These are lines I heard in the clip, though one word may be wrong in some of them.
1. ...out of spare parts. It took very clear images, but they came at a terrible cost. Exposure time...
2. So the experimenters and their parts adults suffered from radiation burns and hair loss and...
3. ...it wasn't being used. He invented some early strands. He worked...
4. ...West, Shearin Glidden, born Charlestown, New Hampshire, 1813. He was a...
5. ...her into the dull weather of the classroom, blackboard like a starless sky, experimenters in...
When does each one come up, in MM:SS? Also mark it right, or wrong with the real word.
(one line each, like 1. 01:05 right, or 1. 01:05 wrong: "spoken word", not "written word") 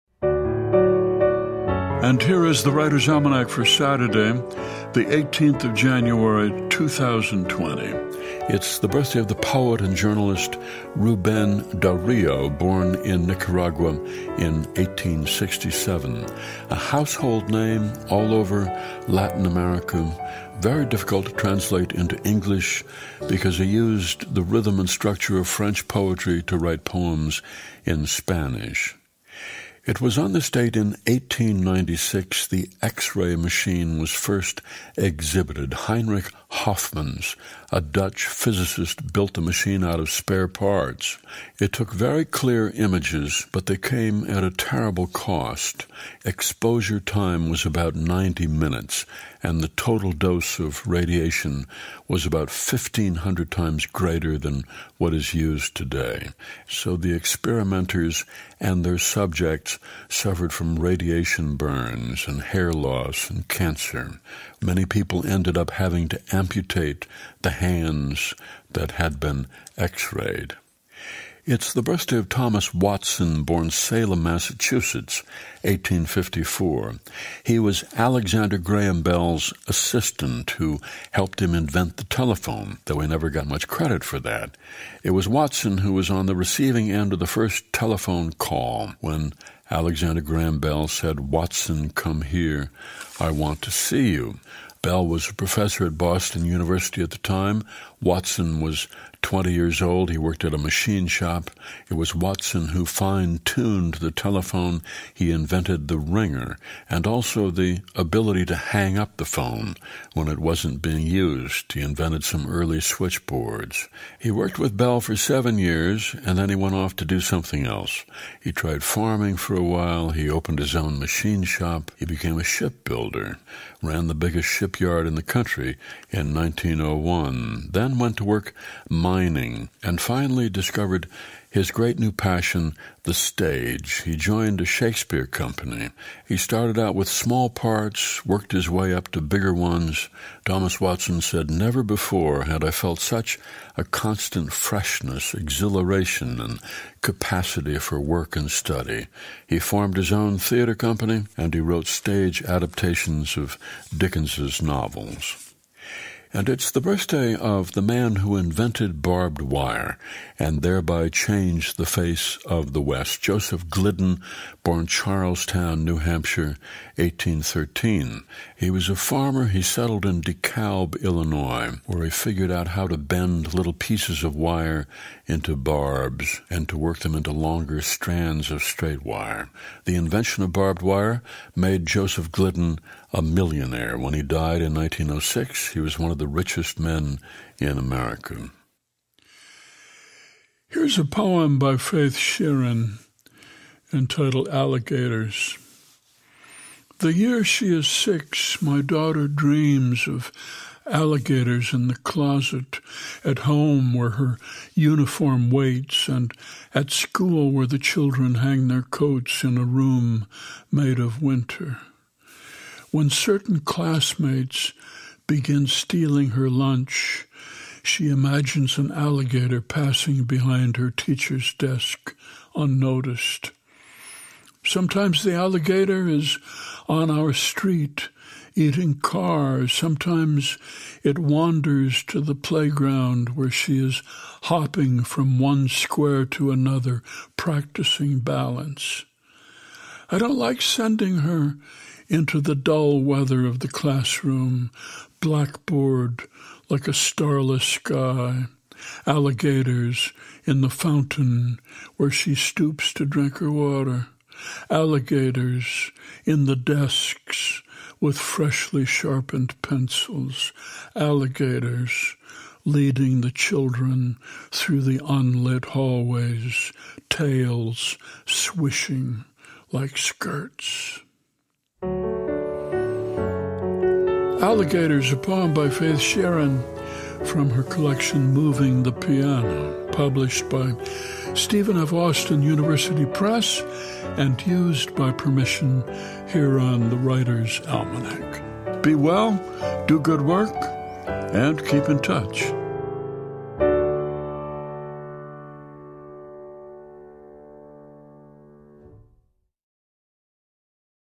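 1. 00:39 right
2. 00:56 wrong: "subjects", not "parts"
3. 01:50 wrong: "switchboards", not "strands"
4. 02:42 wrong: "Joseph", not "Shearin"
5. 04:01 wrong: "alligators", not "experimenters".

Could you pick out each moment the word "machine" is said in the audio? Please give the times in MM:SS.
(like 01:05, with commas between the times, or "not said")
00:33, 00:39, 01:40, 02:00.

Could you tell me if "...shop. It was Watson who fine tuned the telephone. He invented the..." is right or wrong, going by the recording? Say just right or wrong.
right.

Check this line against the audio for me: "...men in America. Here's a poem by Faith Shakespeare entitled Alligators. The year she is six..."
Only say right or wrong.
wrong.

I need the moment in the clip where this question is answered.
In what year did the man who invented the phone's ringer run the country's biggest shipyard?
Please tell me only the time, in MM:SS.
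02:06.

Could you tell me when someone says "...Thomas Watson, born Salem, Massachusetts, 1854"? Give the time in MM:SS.
01:12.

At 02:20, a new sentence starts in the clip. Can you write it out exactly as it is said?
Thomas Watson said, Never before had I felt such a constant freshness, exhilaration, and capacity for work and study.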